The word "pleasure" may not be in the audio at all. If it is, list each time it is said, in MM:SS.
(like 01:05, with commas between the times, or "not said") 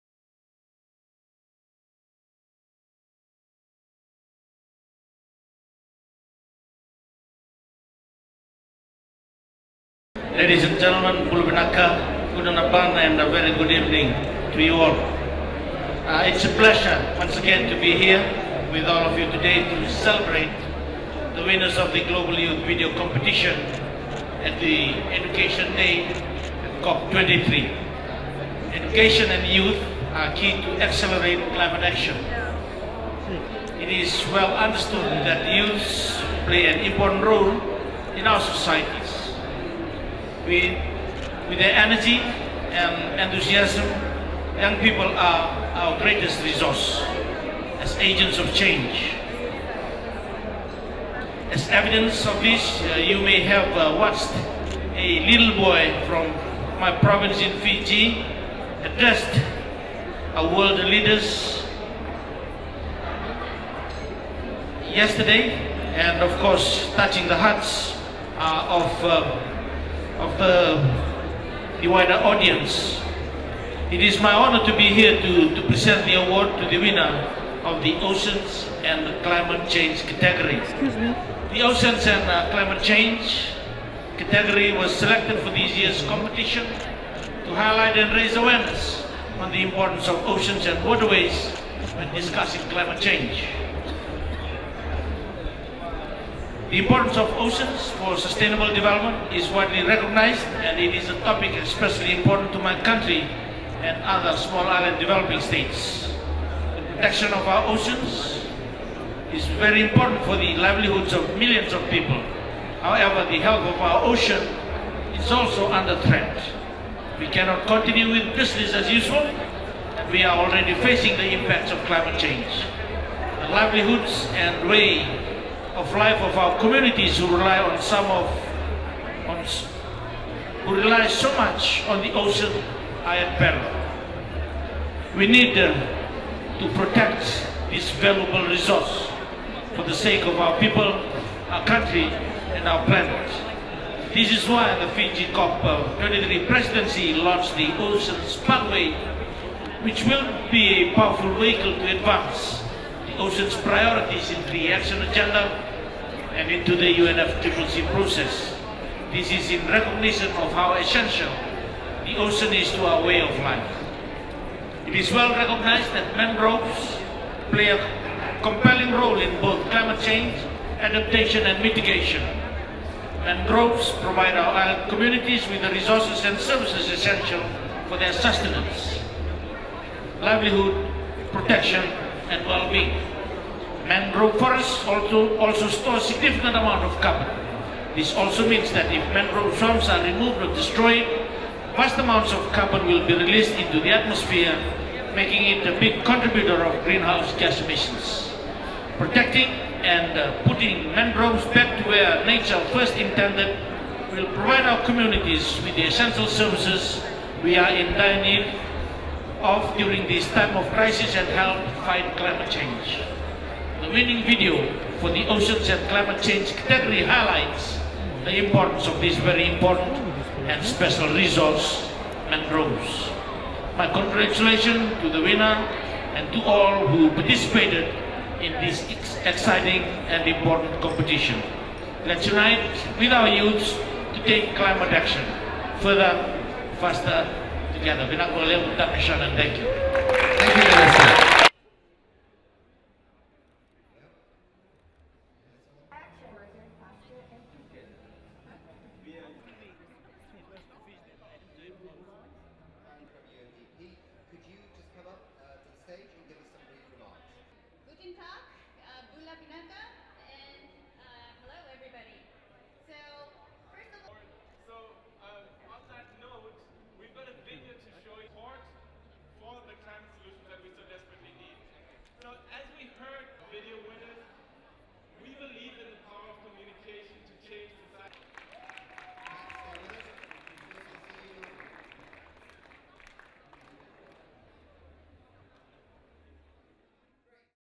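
00:16.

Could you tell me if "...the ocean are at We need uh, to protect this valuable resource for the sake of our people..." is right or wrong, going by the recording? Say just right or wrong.
right.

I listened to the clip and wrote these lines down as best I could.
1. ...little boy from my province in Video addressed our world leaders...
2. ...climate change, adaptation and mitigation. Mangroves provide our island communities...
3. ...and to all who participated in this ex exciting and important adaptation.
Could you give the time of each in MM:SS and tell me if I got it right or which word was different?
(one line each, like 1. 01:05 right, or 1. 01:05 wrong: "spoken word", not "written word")
1. 00:55 wrong: "Fiji", not "Video"
2. 02:49 right
3. 03:46 wrong: "competition", not "adaptation".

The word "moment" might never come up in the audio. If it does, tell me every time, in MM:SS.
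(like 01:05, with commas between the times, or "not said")
not said.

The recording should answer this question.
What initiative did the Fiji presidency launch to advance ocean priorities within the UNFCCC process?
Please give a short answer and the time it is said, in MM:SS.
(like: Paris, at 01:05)
Oceans Pathway, at 02:27.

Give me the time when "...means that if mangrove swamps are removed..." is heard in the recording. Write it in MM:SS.
03:08.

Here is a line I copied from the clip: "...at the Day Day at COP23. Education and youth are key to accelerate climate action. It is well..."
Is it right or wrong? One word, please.
wrong.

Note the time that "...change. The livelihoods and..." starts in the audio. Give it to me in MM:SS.
02:02.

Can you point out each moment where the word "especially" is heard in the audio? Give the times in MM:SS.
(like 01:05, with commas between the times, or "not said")
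01:41.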